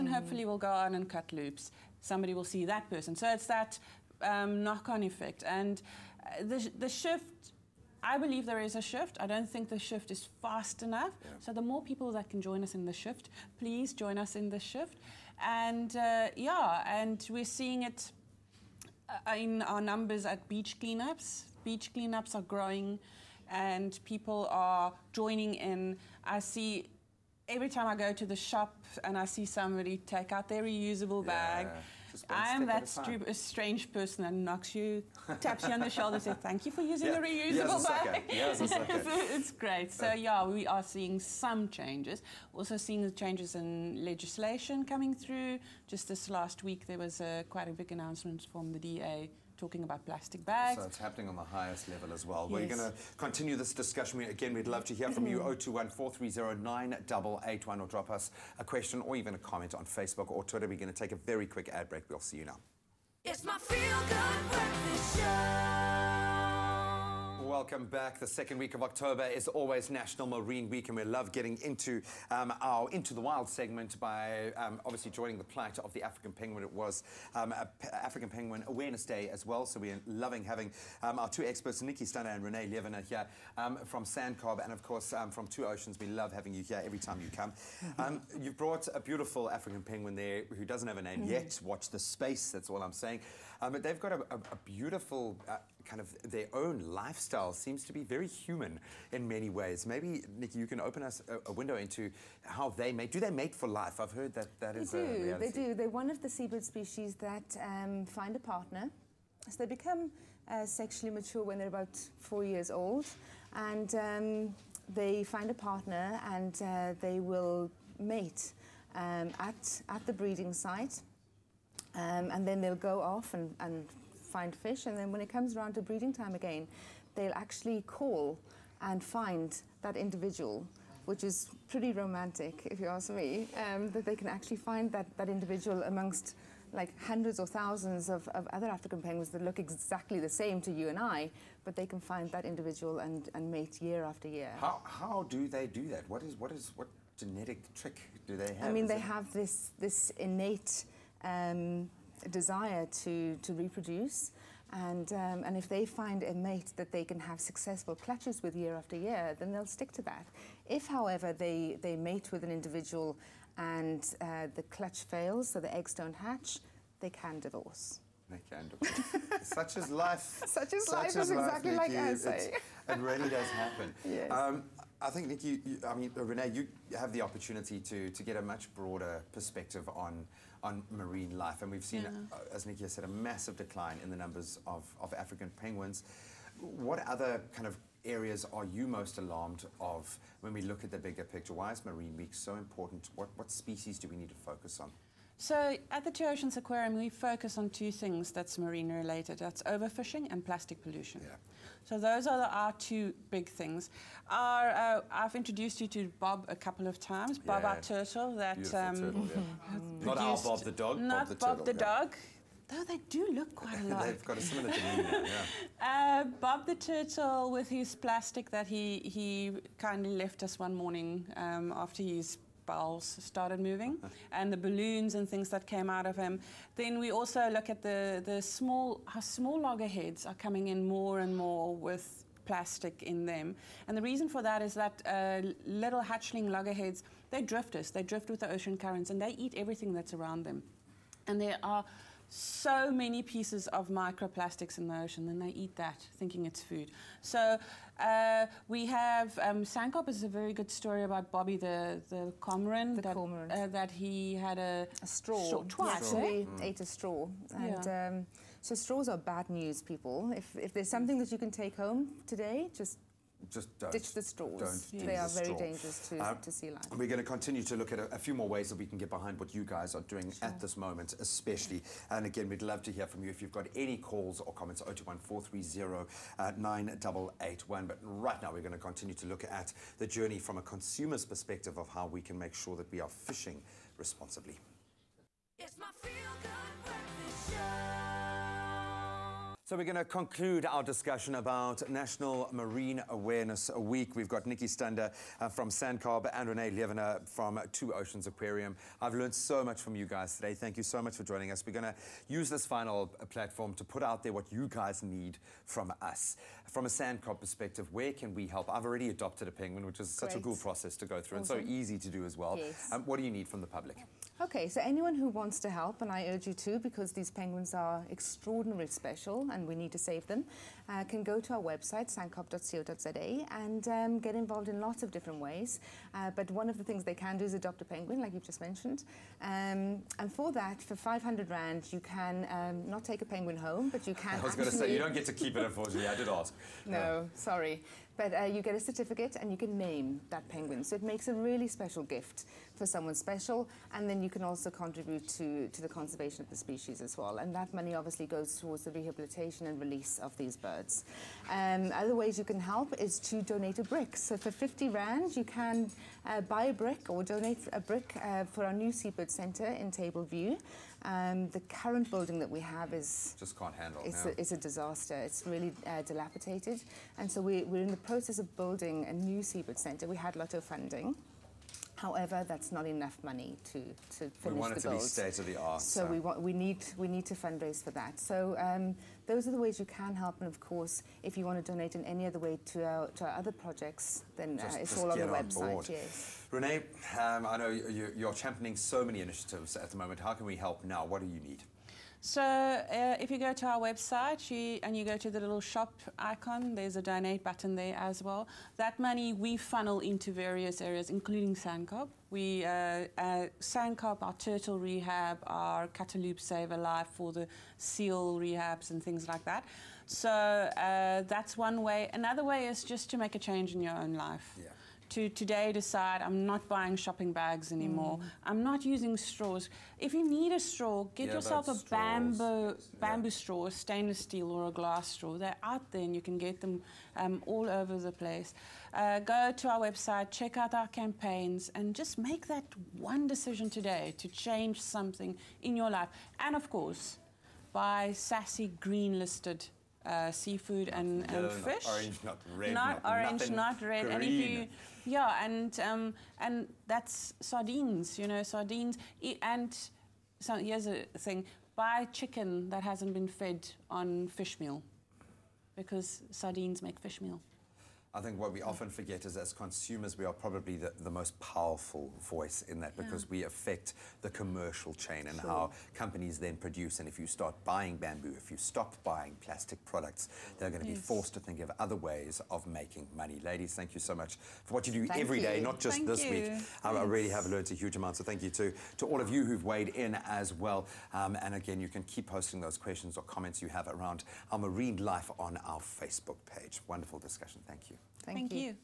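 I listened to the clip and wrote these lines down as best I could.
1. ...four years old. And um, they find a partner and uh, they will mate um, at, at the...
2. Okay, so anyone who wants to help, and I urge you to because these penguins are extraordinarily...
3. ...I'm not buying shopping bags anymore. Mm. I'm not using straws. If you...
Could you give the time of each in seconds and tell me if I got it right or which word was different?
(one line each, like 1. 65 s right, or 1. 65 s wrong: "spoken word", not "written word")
1. 112 s right
2. 314 s right
3. 416 s right.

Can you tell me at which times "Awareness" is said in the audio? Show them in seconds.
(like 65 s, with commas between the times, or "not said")
78 s, 293 s.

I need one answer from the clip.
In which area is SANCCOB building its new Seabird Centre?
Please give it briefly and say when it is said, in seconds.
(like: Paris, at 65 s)
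Table View, at 359 s.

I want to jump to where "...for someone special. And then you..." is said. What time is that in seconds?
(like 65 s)
342 s.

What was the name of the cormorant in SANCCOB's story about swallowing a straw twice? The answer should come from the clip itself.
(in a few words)
Bobby.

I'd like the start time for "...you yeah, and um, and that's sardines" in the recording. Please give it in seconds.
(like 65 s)
444 s.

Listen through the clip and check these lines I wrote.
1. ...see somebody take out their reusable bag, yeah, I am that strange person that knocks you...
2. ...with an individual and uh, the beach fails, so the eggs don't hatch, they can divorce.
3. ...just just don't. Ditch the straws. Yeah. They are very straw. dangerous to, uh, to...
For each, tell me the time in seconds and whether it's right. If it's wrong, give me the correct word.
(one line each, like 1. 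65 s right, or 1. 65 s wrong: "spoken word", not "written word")
1. 29 s right
2. 162 s wrong: "clutch", not "beach"
3. 262 s right.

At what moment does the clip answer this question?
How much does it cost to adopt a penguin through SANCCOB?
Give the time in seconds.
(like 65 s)
330 s.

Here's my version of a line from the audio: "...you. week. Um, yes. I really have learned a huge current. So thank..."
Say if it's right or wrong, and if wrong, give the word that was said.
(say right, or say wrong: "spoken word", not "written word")
wrong: "amount", not "current".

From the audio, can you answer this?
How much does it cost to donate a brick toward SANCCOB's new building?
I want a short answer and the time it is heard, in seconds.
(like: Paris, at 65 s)
50 rand, at 354 s.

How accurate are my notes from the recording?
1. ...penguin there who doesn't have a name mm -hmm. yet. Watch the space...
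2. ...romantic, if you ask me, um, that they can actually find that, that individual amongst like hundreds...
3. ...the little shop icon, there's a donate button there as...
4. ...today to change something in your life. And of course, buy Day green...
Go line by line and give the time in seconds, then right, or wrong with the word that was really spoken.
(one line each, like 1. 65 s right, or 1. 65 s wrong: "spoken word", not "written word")
1. 89 s right
2. 131 s right
3. 395 s right
4. 433 s wrong: "SASSI", not "Day".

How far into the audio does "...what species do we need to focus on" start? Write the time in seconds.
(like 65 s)
193 s.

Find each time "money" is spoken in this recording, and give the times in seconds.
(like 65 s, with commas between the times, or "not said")
347 s, 373 s, 398 s, 473 s.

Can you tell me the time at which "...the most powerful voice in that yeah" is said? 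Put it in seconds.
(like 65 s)
461 s.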